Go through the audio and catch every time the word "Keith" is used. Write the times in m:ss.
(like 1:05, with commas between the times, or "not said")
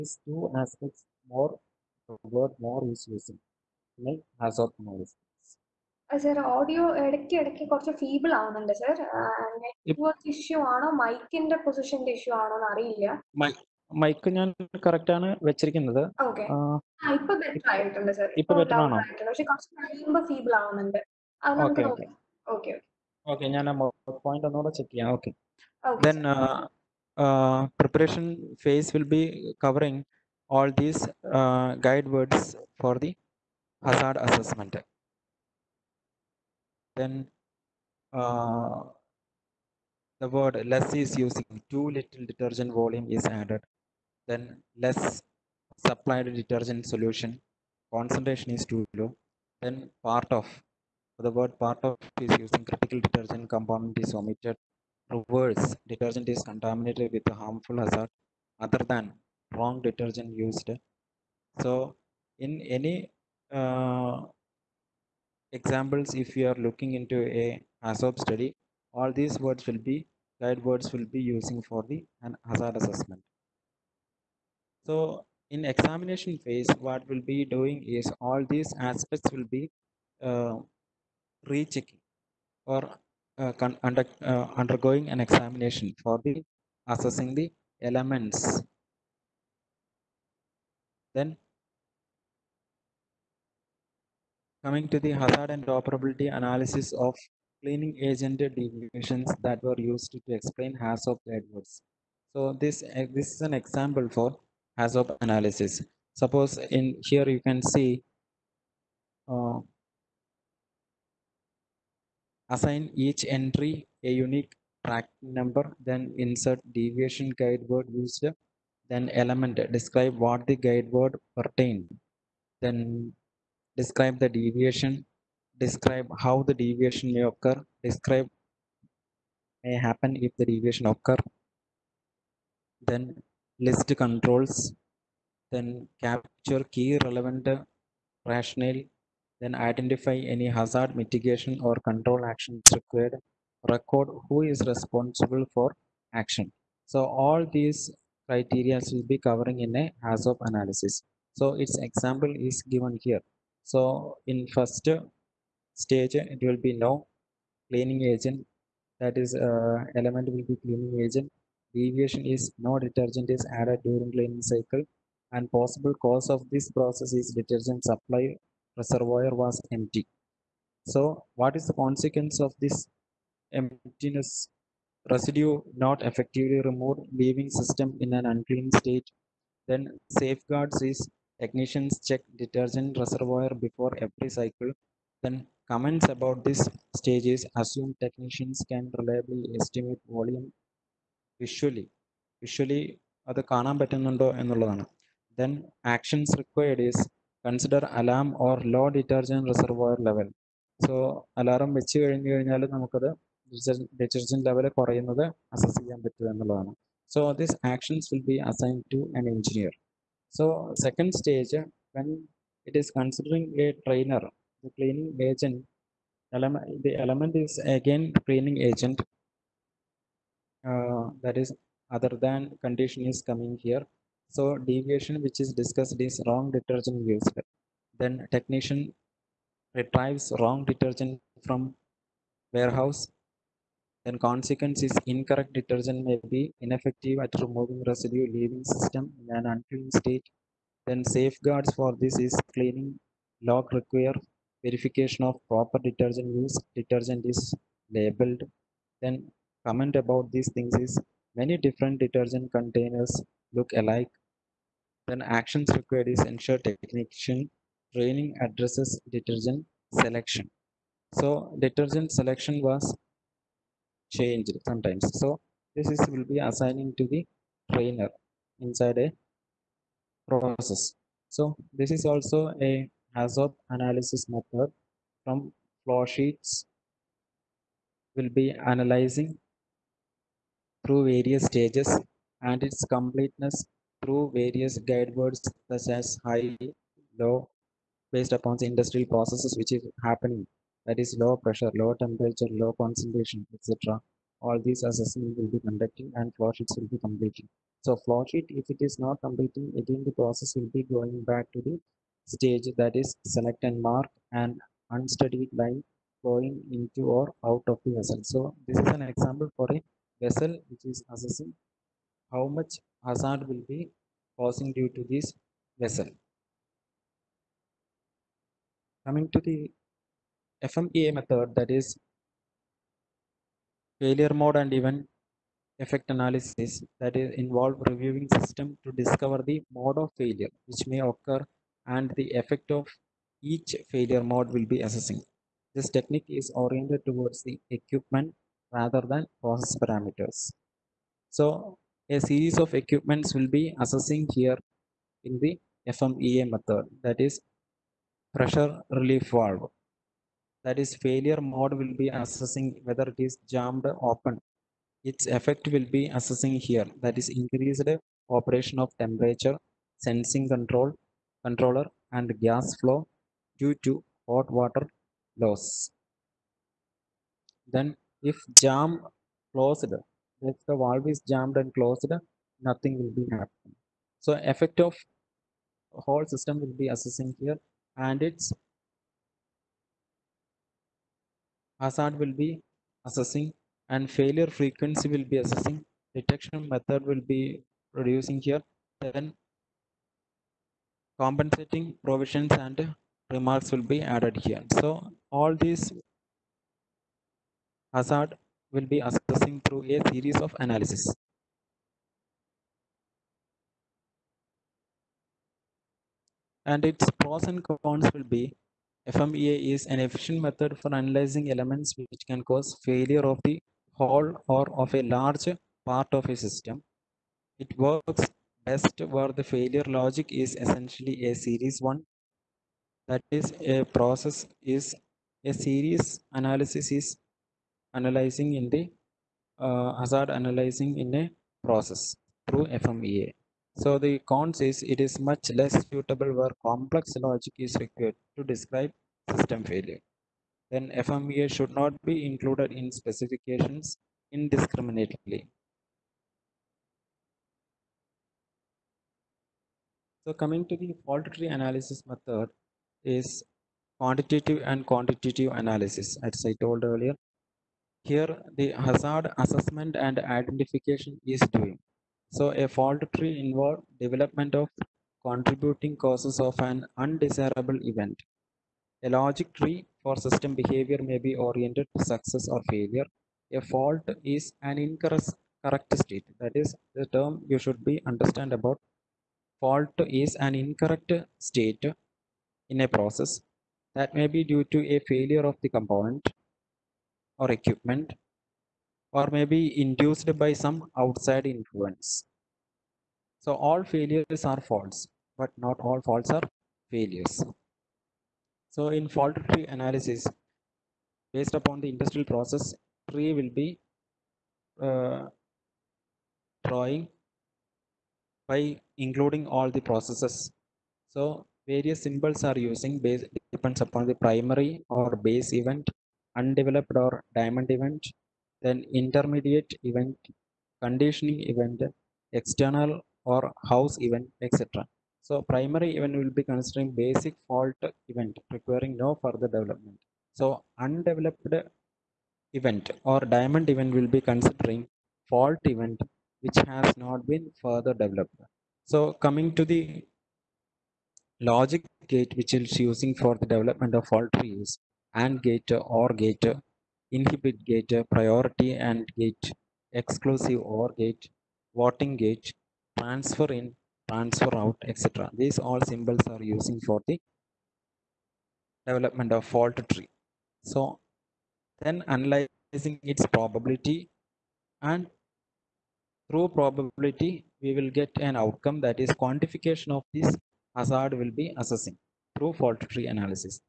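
not said.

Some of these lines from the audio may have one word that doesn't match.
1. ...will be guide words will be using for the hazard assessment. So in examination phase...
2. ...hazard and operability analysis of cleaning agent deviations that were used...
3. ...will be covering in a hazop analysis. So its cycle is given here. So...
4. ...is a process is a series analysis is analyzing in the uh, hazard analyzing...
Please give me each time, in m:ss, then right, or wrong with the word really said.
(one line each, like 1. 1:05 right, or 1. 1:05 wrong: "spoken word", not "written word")
1. 1:09 right
2. 1:35 right
3. 2:28 wrong: "example", not "cycle"
4. 7:03 right.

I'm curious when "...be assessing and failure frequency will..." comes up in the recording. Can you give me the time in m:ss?
6:22.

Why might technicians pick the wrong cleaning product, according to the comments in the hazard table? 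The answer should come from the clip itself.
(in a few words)
Containers look alike.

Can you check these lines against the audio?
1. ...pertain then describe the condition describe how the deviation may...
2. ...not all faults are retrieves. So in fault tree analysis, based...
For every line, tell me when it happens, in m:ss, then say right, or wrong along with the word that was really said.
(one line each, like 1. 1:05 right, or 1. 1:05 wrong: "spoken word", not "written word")
1. 2:01 wrong: "deviation", not "condition"
2. 8:15 wrong: "failures", not "retrieves".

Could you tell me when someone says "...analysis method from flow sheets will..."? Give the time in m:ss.
4:33.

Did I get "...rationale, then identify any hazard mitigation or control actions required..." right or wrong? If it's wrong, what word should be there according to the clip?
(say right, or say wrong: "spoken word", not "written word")
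right.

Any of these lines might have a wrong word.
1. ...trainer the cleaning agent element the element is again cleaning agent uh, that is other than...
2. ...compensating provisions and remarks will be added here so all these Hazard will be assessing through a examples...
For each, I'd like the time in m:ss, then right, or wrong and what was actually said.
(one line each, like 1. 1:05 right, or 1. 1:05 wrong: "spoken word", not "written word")
1. 3:33 right
2. 6:31 wrong: "series", not "examples".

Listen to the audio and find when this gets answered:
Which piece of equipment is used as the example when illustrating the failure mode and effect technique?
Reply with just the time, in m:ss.
5:48.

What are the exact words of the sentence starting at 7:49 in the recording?
A logic tree for system behavior may be oriented to success or failure.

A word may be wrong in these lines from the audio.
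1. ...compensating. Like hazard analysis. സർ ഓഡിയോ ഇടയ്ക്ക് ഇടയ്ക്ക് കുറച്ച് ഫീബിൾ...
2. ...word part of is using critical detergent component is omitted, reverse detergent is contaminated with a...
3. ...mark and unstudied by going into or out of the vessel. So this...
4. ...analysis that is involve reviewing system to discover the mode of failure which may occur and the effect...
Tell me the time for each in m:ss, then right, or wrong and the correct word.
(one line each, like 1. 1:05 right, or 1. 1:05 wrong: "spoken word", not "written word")
1. 0:03 wrong: "using", not "compensating"
2. 0:51 right
3. 5:03 right
4. 5:26 right.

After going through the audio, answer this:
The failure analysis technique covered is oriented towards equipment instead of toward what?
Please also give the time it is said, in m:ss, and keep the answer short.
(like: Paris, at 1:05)
Process parameters, at 5:39.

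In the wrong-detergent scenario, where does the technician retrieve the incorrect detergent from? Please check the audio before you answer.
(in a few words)
Warehouse.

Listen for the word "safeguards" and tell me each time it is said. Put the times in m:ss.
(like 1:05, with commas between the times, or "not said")
3:00, 4:01.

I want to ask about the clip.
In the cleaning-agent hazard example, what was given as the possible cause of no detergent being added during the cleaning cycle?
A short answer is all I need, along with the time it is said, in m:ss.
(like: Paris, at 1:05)
Detergent supply reservoir was empty, at 2:47.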